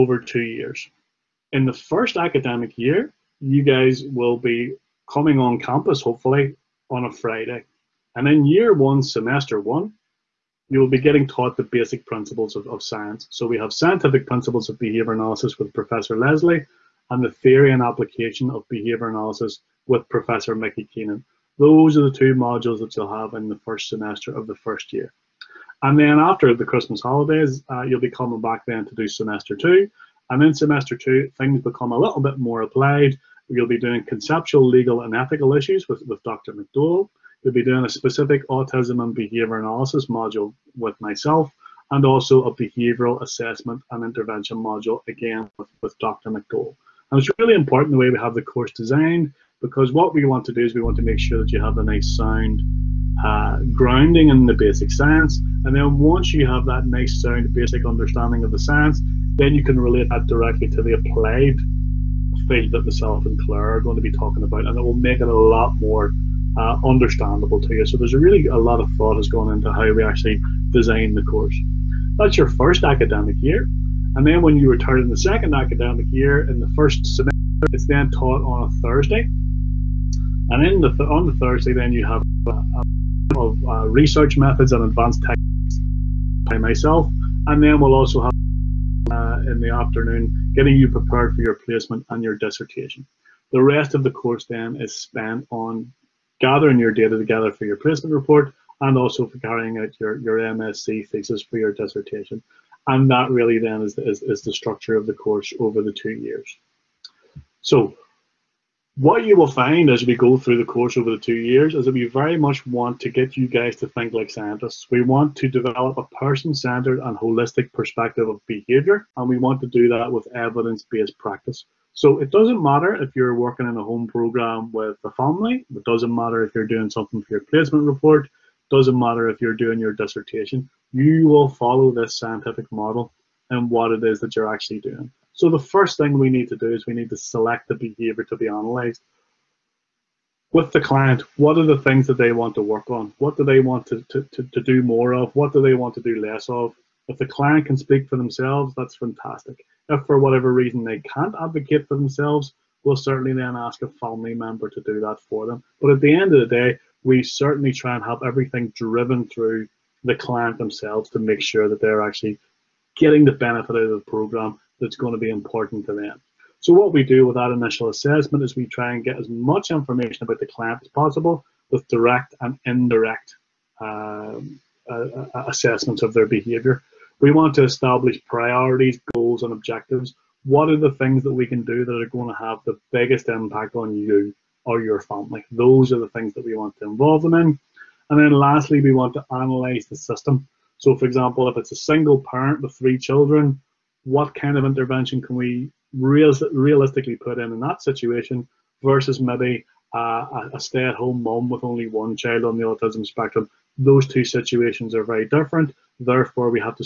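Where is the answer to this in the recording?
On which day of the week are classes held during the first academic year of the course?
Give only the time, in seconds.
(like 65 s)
7 s.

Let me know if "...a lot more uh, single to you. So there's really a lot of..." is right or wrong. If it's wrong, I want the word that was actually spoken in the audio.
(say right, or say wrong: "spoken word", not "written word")
wrong: "understandable", not "single".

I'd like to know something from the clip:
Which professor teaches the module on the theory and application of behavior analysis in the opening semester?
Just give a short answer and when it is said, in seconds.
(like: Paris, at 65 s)
Mickey Keenan, at 20 s.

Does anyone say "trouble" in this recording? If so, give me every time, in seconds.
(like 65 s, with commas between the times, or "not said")
not said.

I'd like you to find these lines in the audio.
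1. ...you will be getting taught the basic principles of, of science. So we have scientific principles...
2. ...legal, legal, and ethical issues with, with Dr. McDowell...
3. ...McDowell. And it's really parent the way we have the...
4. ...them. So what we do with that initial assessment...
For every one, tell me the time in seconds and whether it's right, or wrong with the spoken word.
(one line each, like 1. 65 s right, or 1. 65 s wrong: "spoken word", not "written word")
1. 10 s right
2. 34 s wrong: "conceptual", not "legal"
3. 46 s wrong: "important", not "parent"
4. 165 s right.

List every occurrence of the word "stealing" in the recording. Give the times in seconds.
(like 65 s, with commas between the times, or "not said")
not said.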